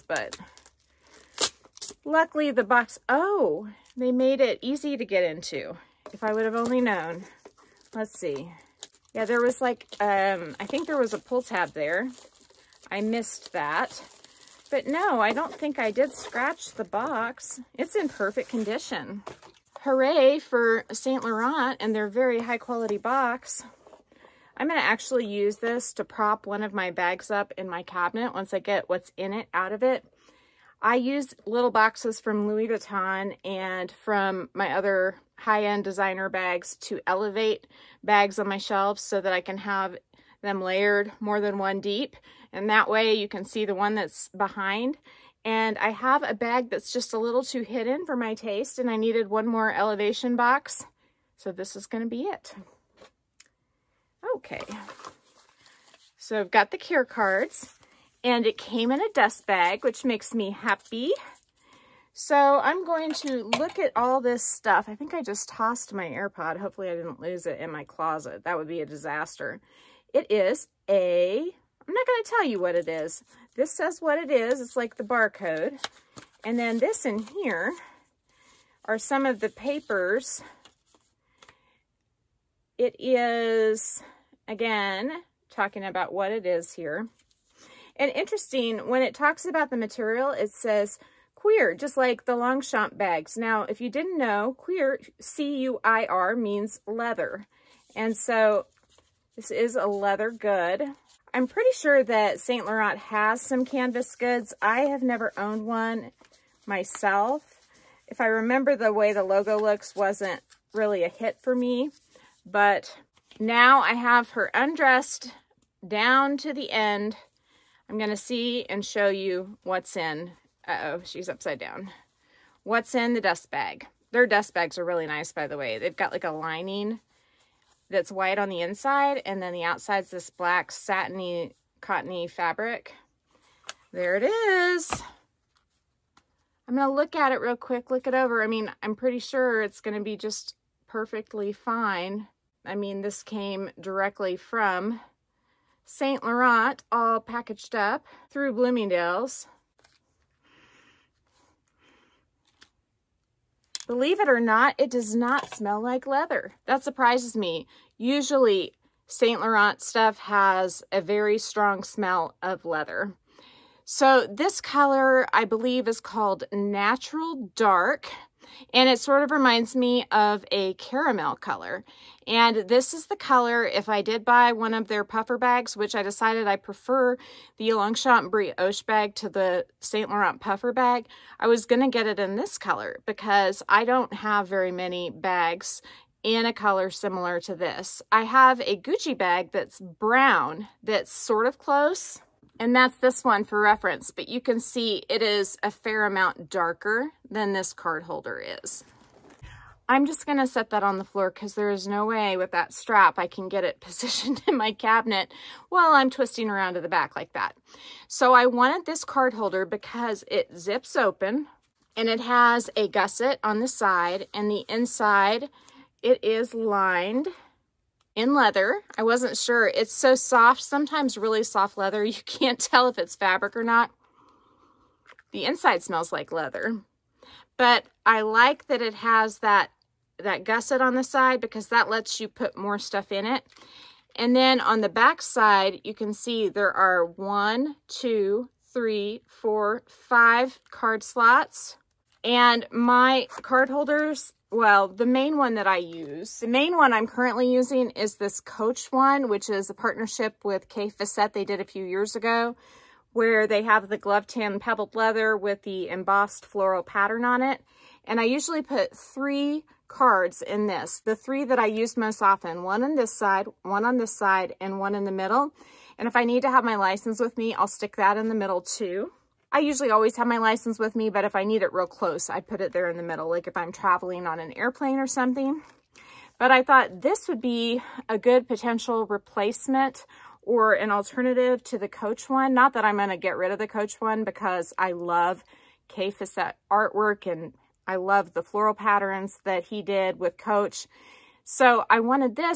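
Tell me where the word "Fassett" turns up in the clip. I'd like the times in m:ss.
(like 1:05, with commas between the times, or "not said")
4:10, 4:46.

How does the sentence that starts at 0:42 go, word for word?
And that way you can see the one that's behind.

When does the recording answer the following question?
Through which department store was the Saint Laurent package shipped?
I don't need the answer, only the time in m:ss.
2:28.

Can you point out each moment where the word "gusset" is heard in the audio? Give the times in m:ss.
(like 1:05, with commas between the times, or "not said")
3:32, 3:50.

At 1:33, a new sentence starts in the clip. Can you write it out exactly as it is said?
Now, if you didn't know, cuir, C-U-I-R, means leather.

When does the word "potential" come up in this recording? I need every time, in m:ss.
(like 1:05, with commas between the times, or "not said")
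4:38.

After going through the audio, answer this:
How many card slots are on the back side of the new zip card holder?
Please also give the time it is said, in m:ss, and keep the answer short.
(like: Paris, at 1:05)
5, at 3:59.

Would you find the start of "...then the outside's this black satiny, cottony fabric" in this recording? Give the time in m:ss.
2:09.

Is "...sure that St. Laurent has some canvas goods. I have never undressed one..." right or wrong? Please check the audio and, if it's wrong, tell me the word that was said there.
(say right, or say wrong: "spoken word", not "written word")
wrong: "owned", not "undressed".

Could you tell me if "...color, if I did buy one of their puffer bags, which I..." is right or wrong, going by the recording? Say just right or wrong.
right.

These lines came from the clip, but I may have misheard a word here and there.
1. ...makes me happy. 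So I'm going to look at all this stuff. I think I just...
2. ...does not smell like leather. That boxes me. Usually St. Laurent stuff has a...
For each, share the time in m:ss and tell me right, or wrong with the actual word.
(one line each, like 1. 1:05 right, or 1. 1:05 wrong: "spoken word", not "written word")
1. 1:00 right
2. 2:34 wrong: "surprises", not "boxes".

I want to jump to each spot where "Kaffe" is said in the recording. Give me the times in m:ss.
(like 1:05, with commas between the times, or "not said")
4:10, 4:45.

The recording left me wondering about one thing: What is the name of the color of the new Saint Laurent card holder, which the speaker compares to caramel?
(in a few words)
Natural Dark.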